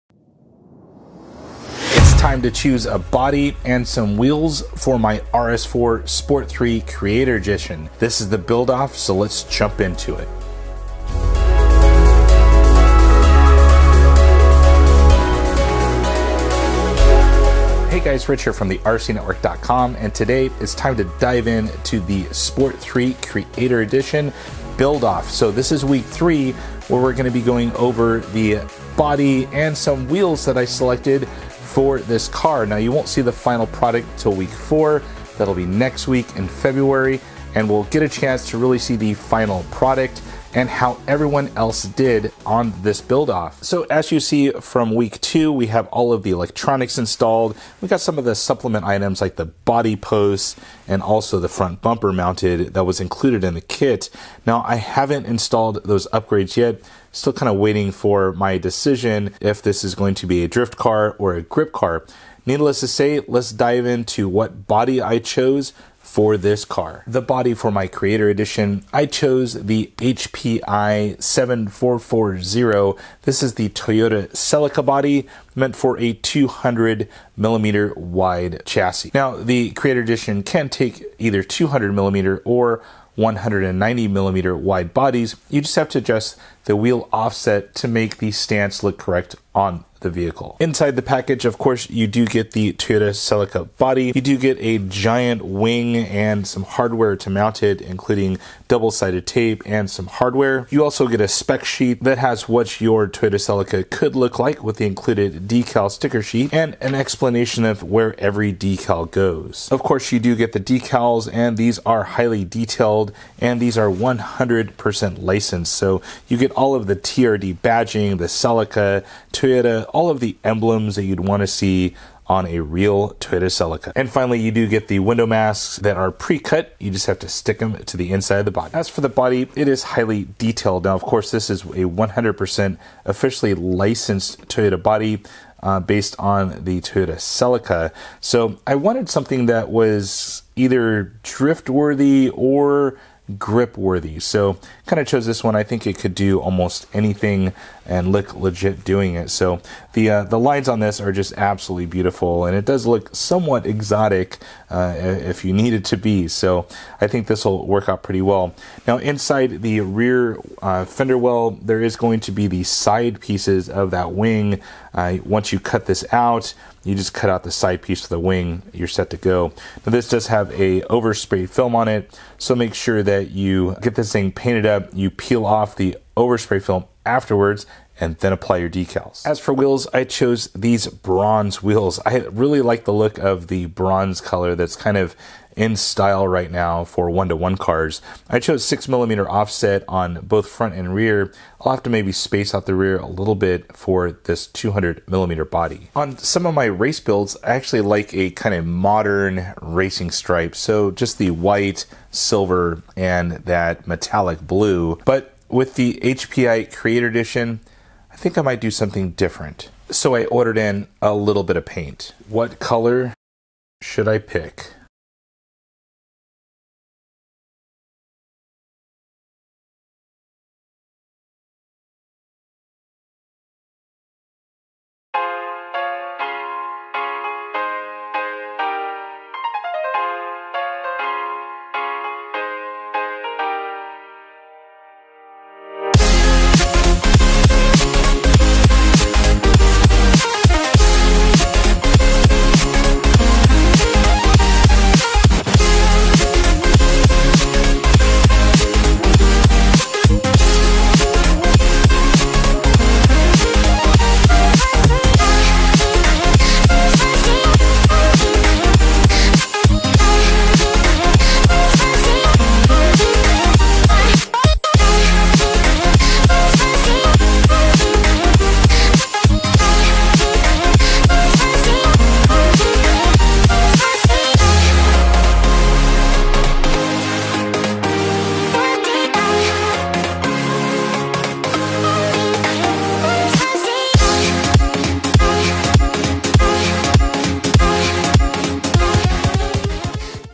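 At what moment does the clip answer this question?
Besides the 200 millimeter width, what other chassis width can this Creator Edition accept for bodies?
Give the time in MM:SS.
01:23.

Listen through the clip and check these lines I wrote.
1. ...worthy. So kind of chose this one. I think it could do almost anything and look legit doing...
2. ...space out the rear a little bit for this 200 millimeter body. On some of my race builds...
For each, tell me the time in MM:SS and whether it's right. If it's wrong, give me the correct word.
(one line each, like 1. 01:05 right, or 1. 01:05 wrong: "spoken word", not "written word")
1. 02:23 right
2. 03:12 right.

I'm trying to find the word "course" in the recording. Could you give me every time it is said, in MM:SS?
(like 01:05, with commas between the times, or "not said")
01:31, 01:49, 02:11.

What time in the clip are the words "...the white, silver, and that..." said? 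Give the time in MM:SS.
03:21.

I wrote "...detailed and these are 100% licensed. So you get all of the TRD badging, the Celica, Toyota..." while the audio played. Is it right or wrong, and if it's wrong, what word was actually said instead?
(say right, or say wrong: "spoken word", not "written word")
right.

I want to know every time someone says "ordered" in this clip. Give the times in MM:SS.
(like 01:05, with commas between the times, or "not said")
03:30.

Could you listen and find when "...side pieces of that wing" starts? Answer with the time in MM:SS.
02:42.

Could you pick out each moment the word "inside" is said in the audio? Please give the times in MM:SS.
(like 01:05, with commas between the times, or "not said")
01:30, 02:08, 02:38.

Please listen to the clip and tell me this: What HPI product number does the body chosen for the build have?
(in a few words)
7440.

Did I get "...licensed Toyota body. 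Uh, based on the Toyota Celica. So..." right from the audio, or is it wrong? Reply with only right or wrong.
right.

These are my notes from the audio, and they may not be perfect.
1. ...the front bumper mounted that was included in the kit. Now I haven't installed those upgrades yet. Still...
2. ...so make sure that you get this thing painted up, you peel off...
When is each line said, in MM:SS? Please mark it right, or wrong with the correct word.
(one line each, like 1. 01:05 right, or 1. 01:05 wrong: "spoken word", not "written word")
1. 00:51 right
2. 02:52 right.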